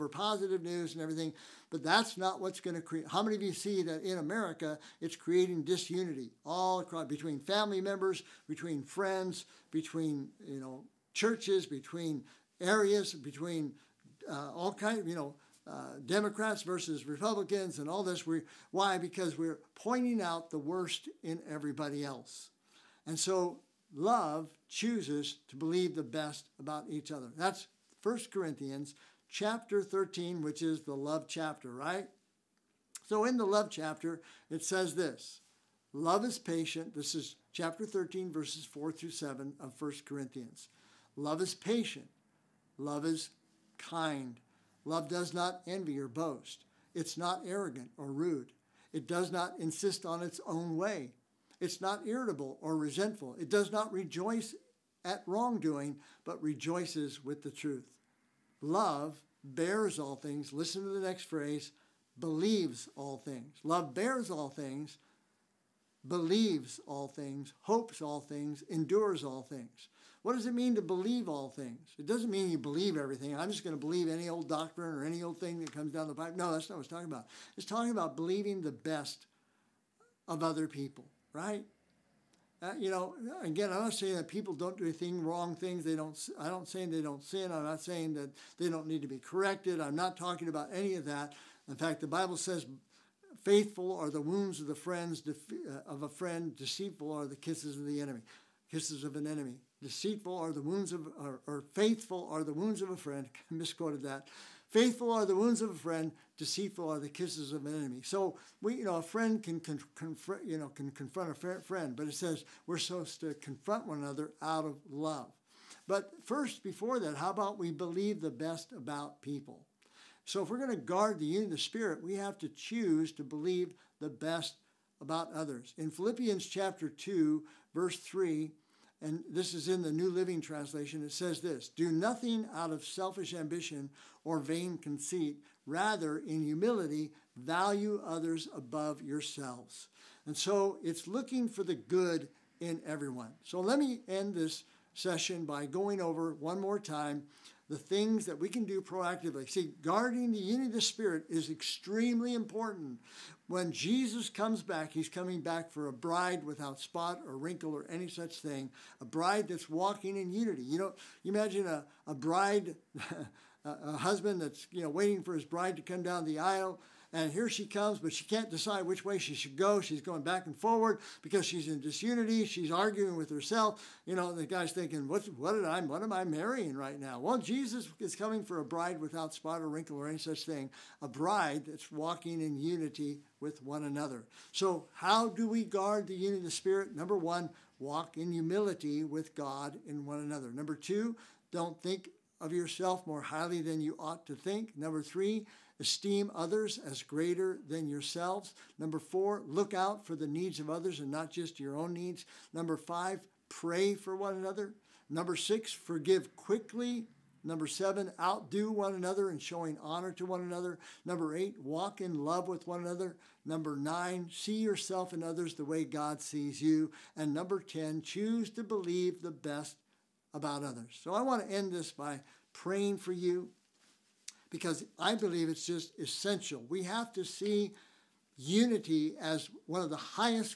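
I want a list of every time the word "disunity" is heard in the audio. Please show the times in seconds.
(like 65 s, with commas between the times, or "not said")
5 s, 171 s.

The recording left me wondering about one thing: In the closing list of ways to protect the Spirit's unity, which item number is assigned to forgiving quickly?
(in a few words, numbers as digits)
6.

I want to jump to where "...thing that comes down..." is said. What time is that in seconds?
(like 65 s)
75 s.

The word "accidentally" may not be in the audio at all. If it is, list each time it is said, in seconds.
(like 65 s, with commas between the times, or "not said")
not said.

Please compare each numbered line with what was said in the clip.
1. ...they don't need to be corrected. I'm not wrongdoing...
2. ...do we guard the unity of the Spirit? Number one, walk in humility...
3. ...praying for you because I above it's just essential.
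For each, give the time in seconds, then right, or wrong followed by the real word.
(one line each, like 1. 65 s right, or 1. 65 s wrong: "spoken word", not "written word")
1. 88 s wrong: "talking", not "wrongdoing"
2. 185 s right
3. 222 s wrong: "believe", not "above".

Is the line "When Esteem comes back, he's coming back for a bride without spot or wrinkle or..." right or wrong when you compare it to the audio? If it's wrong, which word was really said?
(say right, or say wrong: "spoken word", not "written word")
wrong: "Jesus", not "Esteem".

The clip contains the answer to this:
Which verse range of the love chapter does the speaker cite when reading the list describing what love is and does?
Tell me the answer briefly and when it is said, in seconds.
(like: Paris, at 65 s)
4 through 7, at 38 s.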